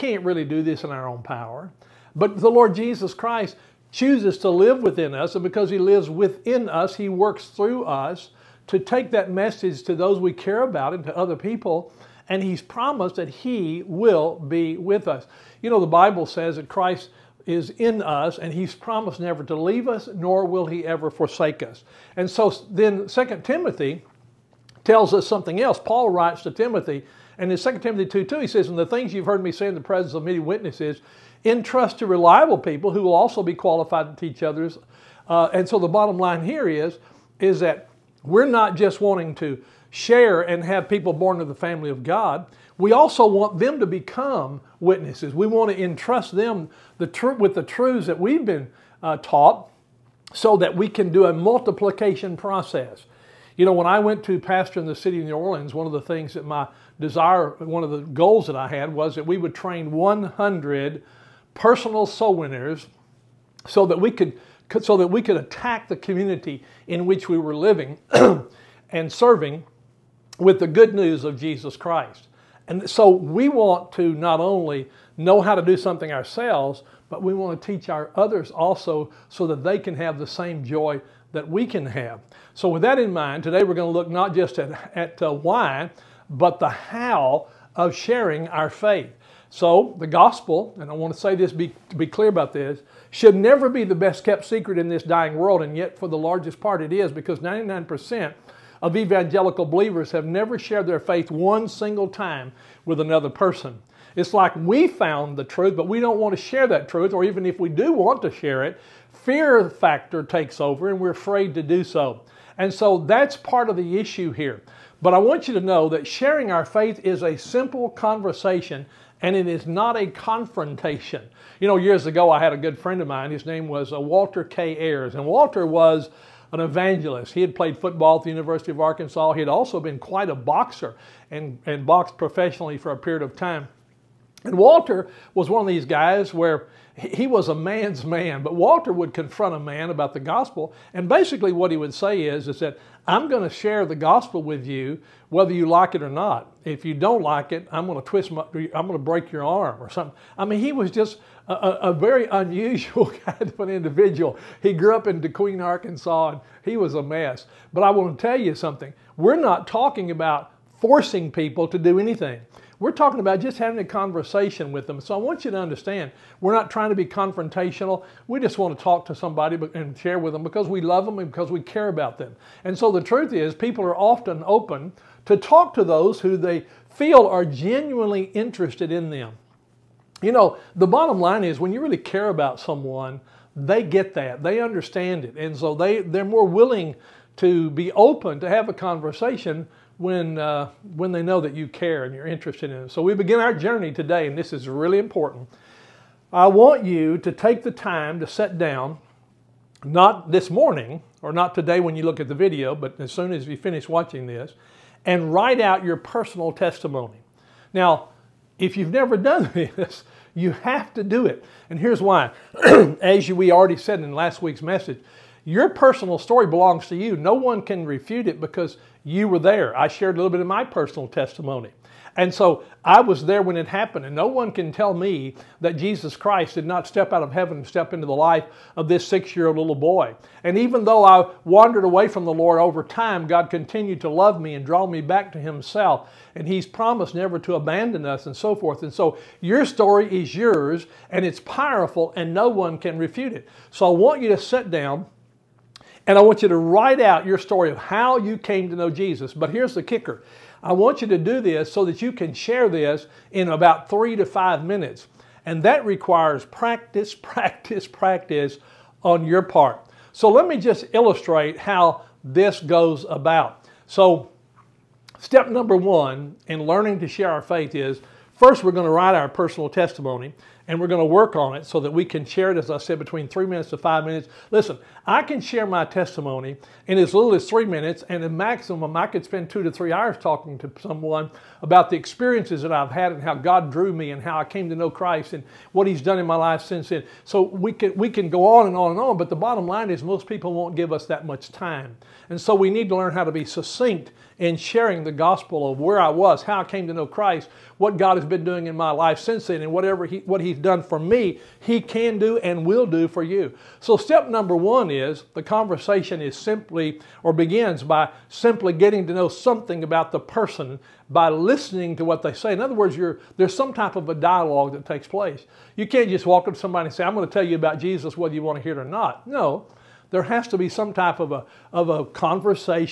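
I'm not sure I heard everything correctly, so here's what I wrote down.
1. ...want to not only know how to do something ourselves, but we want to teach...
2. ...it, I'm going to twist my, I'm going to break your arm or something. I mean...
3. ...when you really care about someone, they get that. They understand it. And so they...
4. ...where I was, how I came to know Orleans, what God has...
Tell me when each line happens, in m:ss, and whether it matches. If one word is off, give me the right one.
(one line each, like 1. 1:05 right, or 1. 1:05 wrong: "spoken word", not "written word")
1. 1:13 right
2. 2:27 right
3. 3:01 right
4. 4:55 wrong: "Christ", not "Orleans".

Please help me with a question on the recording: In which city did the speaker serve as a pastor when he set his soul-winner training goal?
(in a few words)
New Orleans.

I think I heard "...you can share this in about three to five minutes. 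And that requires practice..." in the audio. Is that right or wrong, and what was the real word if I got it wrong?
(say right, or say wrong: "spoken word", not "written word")
right.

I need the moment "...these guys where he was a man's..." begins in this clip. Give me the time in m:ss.
2:15.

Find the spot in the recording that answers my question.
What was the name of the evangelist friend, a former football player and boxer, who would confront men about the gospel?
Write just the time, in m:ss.
2:03.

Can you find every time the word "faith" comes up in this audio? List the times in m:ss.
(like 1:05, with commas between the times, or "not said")
1:28, 1:40, 1:56, 4:27.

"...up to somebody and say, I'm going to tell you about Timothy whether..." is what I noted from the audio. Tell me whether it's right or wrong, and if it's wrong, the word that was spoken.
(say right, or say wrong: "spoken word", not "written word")
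wrong: "Jesus", not "Timothy".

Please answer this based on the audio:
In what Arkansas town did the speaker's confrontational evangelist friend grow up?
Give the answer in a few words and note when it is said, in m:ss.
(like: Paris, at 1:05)
DeQueen, at 2:35.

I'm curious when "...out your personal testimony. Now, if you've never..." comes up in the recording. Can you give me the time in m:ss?
3:25.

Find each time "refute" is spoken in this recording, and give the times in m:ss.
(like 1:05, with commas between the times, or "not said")
3:37, 4:02.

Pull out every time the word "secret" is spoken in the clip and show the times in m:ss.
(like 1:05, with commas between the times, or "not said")
1:34.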